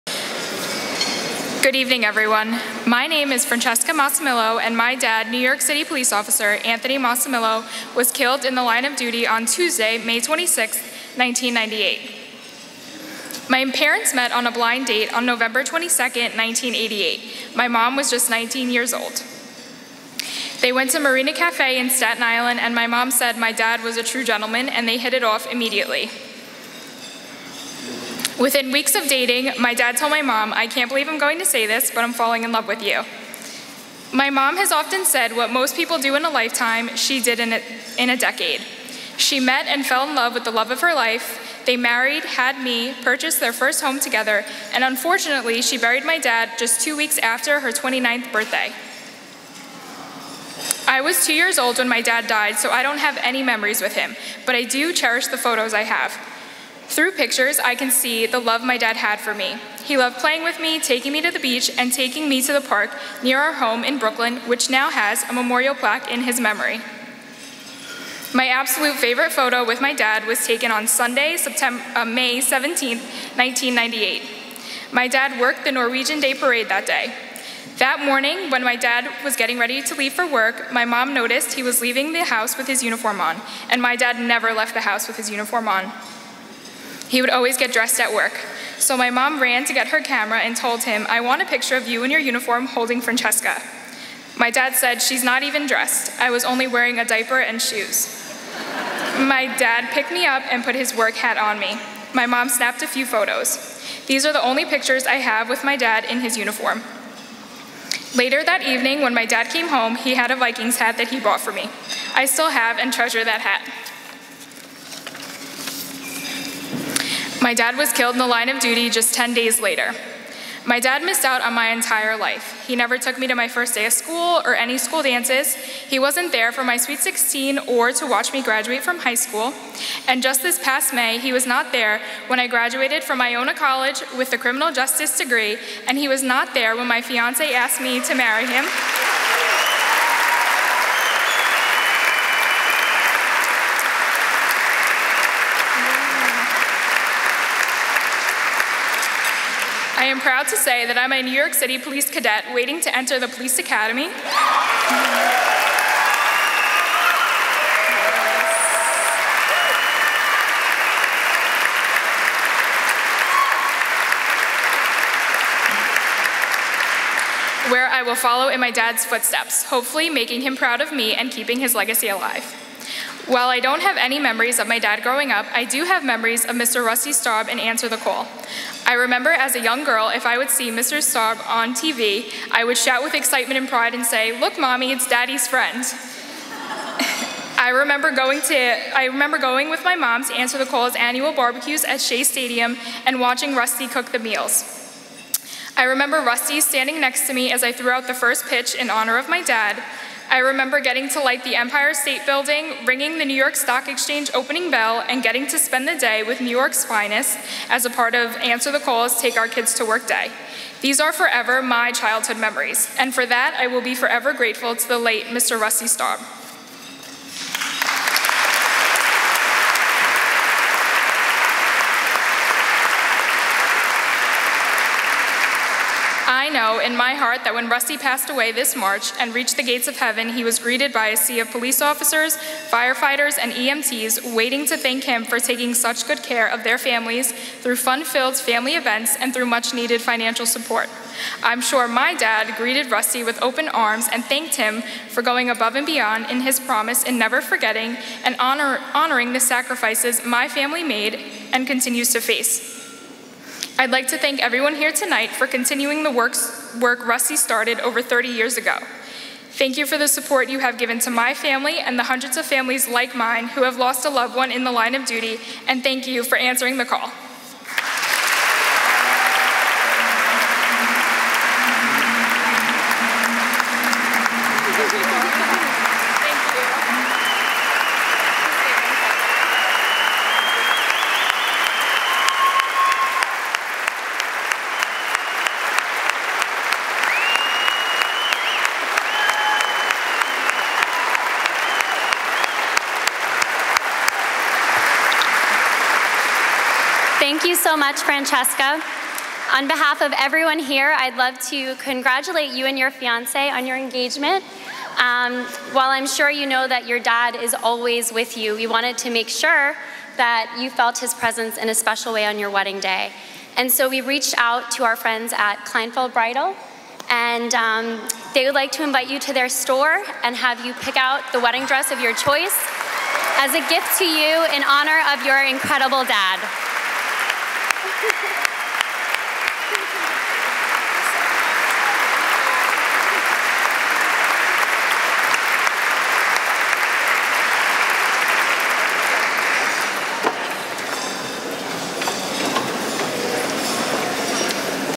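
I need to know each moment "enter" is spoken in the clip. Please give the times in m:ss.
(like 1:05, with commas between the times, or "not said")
2:32.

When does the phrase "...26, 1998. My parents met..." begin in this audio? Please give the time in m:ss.
0:10.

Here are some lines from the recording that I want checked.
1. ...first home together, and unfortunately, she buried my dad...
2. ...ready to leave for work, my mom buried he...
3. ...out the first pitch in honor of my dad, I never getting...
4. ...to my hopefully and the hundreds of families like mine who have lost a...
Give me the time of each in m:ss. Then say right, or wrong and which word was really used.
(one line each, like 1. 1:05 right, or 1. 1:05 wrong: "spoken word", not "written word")
1. 0:43 right
2. 1:19 wrong: "noticed", not "buried"
3. 3:17 wrong: "remember", not "never"
4. 4:20 wrong: "family", not "hopefully".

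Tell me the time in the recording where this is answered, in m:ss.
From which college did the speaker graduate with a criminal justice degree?
2:13.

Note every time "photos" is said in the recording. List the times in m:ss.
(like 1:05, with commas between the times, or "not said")
0:55, 1:09, 1:43.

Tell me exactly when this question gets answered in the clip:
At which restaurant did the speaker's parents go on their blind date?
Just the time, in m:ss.
0:20.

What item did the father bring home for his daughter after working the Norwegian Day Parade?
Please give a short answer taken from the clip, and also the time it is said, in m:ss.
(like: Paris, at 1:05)
Vikings hat, at 1:50.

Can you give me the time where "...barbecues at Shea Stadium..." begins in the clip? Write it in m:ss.
3:11.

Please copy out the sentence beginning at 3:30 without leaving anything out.
These are forever my childhood memories, and for that I will be forever grateful to the late Mr.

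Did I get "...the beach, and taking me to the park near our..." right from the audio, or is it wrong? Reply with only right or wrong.
right.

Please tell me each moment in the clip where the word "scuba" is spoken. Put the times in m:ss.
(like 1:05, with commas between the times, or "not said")
not said.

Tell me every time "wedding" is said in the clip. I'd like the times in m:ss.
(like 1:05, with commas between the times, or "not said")
5:12, 5:21.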